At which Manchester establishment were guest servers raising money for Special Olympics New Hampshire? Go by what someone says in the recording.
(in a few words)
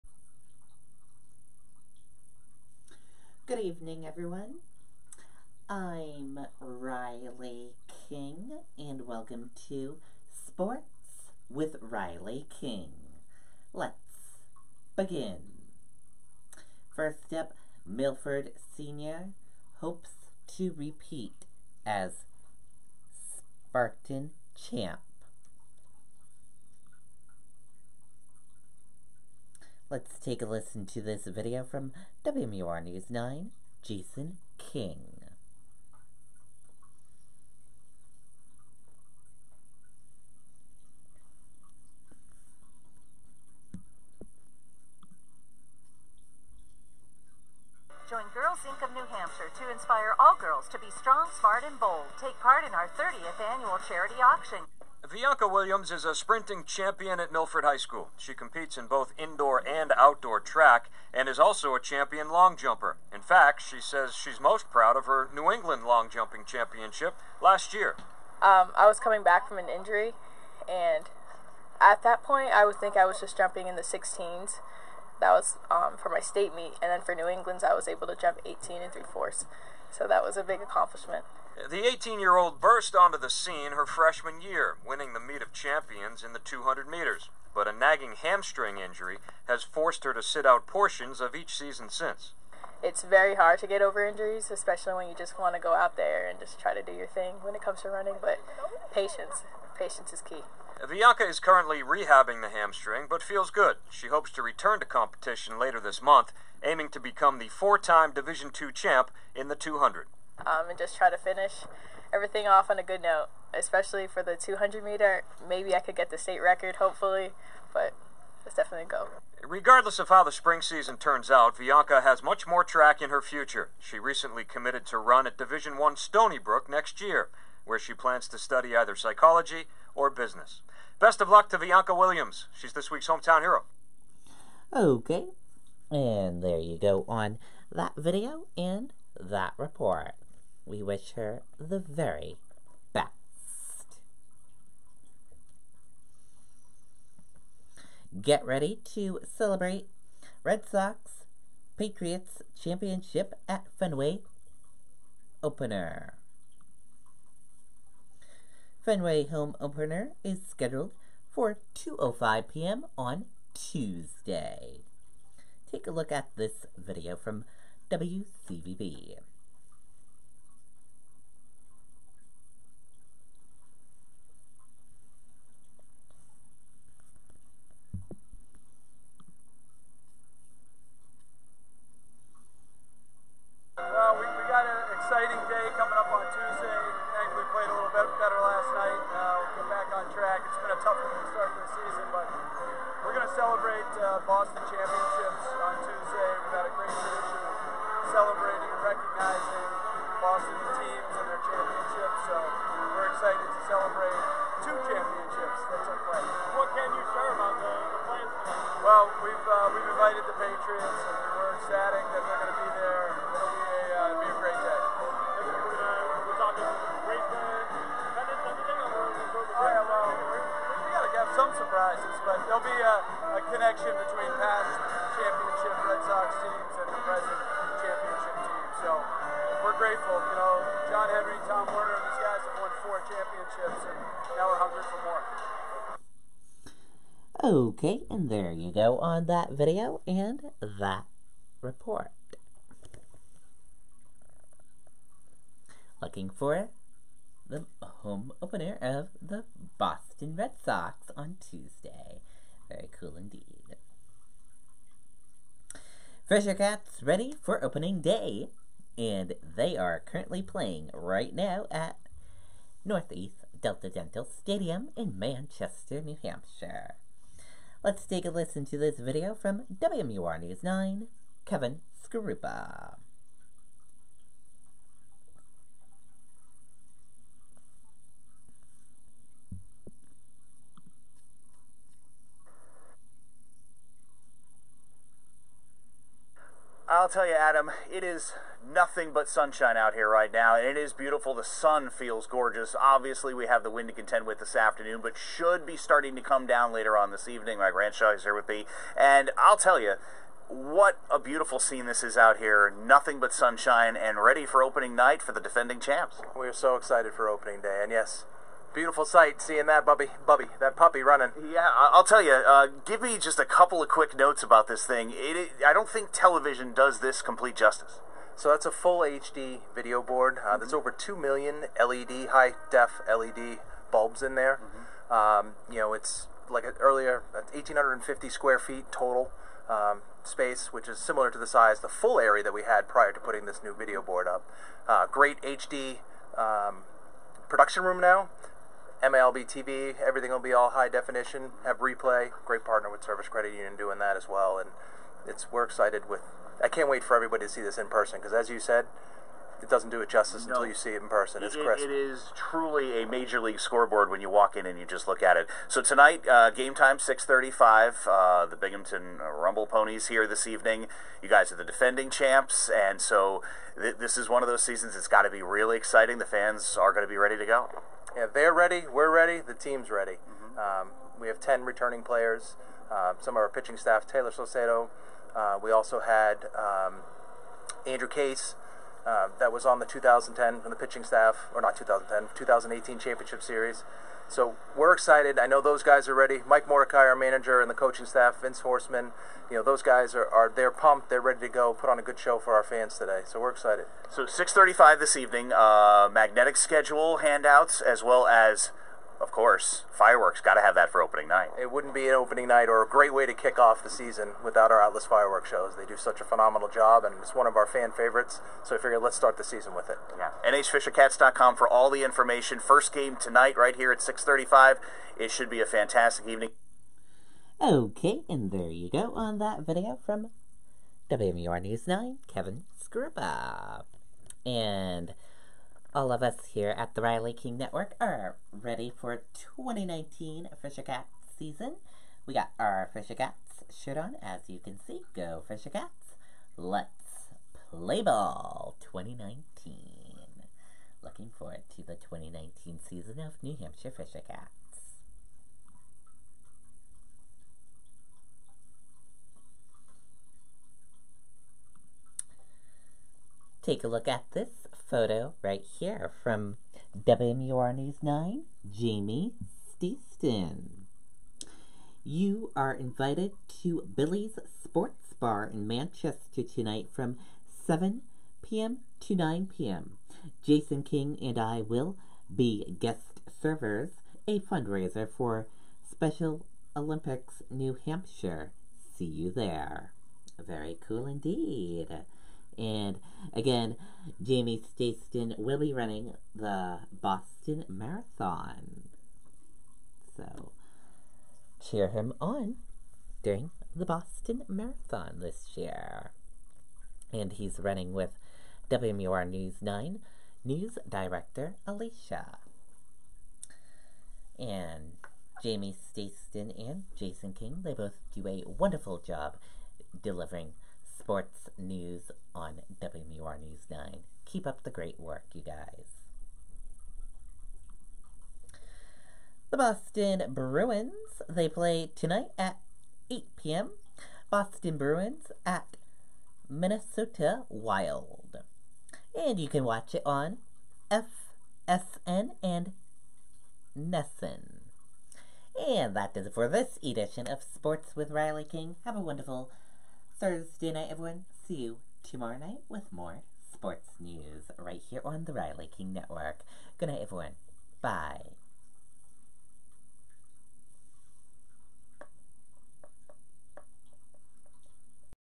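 Billy's Sports Bar.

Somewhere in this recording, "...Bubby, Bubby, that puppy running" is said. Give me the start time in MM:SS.
05:09.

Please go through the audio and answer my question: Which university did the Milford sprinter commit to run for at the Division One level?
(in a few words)
Stony Brook.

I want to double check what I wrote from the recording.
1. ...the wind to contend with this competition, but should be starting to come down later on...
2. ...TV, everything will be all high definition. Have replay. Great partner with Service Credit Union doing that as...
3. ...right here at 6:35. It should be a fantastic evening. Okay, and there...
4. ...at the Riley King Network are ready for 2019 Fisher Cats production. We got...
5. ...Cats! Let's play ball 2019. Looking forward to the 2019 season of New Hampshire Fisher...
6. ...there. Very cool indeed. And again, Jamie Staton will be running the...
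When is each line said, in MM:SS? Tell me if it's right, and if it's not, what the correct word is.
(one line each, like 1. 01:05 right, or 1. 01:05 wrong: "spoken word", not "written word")
1. 04:53 wrong: "afternoon", not "competition"
2. 05:39 right
3. 06:53 right
4. 07:06 wrong: "season", not "production"
5. 07:15 right
6. 07:59 right.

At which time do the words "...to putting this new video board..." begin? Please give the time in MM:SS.
05:33.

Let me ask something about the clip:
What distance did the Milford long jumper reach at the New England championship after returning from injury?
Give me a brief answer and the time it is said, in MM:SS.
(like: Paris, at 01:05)
18 and 3/4, at 01:18.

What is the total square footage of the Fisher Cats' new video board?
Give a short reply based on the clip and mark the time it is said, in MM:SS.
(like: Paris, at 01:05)
1,850, at 05:27.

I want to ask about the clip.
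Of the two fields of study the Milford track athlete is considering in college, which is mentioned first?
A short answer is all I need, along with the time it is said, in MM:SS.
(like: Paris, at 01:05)
psychology, at 02:08.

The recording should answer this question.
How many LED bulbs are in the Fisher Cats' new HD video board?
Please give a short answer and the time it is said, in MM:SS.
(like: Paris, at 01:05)
over 2 million, at 05:20.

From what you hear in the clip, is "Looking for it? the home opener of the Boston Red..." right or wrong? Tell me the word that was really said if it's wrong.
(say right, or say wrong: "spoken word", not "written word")
right.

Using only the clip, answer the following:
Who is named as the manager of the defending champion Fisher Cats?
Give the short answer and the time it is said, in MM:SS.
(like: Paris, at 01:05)
Mike Mordecai, at 06:26.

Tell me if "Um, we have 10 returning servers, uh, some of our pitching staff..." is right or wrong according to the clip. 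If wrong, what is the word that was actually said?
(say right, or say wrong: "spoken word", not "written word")
wrong: "players", not "servers".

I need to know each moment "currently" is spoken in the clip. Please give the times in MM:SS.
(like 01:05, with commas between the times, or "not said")
01:41, 04:19.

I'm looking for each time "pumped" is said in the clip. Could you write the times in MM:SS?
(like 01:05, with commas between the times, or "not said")
06:30.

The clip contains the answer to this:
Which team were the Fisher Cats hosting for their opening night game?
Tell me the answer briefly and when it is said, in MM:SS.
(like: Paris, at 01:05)
Binghamton Rumble Ponies, at 05:58.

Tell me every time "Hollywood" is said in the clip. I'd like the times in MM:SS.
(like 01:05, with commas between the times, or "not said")
not said.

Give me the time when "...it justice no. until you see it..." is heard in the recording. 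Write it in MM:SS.
05:50.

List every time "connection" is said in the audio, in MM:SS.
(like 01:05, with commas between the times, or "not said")
03:43.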